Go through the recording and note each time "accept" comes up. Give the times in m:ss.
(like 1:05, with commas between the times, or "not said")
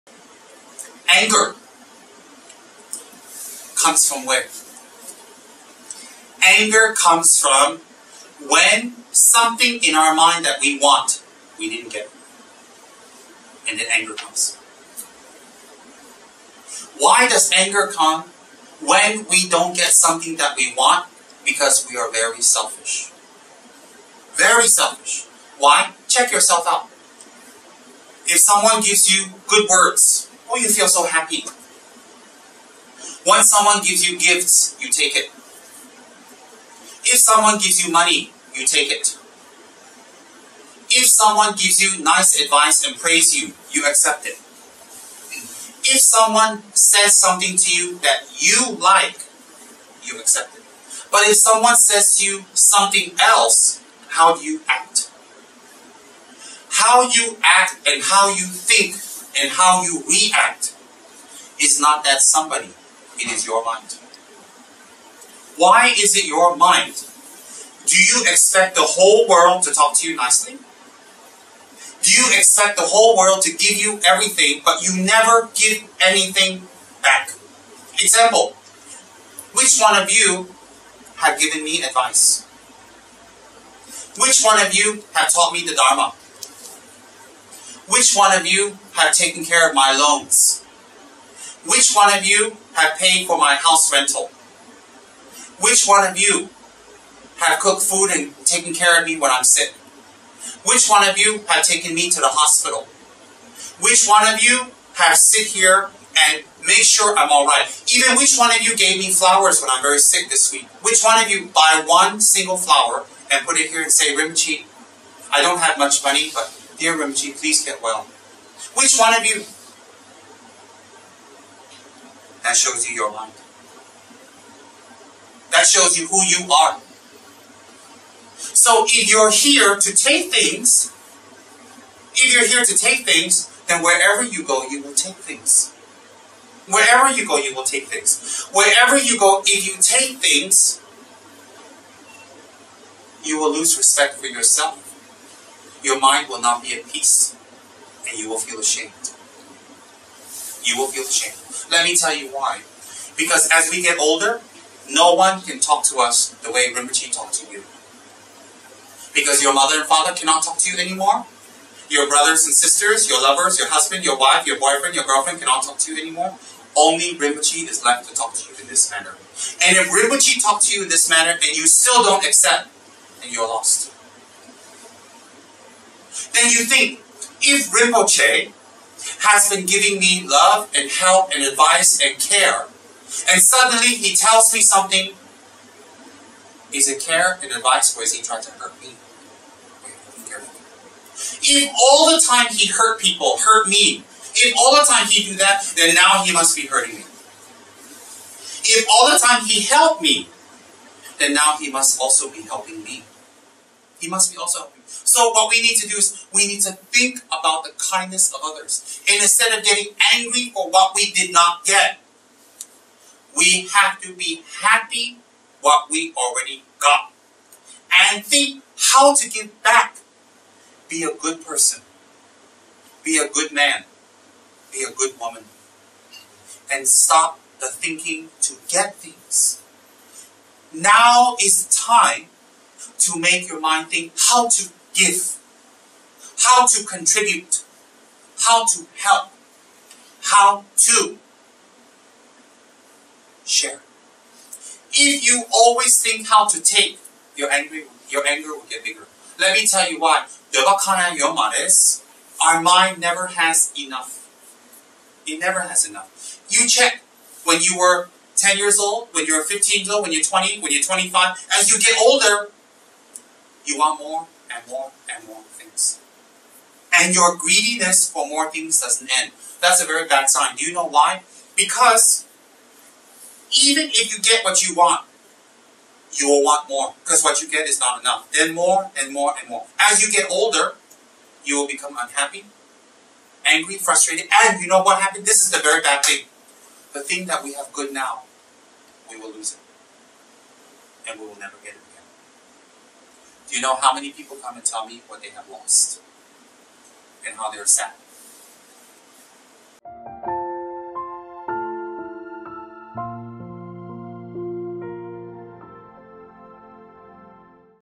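0:43, 0:50, 2:52.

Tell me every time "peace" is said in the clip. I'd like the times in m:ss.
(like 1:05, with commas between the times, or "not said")
2:26.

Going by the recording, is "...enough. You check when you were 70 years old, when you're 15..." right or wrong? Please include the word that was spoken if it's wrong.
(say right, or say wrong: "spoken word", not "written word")
wrong: "10", not "70".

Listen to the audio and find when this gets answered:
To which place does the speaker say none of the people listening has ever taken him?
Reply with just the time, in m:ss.
1:42.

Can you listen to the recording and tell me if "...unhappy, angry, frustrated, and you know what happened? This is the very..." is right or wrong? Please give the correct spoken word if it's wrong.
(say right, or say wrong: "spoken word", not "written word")
right.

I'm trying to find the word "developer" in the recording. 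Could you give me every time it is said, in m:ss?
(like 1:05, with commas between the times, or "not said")
not said.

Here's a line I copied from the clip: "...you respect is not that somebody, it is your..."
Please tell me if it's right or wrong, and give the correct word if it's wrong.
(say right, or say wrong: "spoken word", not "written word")
wrong: "react", not "respect".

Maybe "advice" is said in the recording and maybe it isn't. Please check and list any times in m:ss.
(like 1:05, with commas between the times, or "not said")
0:42, 1:21, 3:01, 3:07.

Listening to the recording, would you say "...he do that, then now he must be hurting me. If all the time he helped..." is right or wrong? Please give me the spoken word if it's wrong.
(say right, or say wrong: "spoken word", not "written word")
right.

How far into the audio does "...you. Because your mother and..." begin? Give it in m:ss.
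2:37.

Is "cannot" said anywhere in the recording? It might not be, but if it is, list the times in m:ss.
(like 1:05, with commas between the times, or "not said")
2:40, 2:45.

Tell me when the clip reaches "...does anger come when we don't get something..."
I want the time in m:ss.
0:17.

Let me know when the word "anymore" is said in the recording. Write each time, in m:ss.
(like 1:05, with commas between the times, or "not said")
2:40, 2:46.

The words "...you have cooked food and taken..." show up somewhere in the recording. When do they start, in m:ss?
1:36.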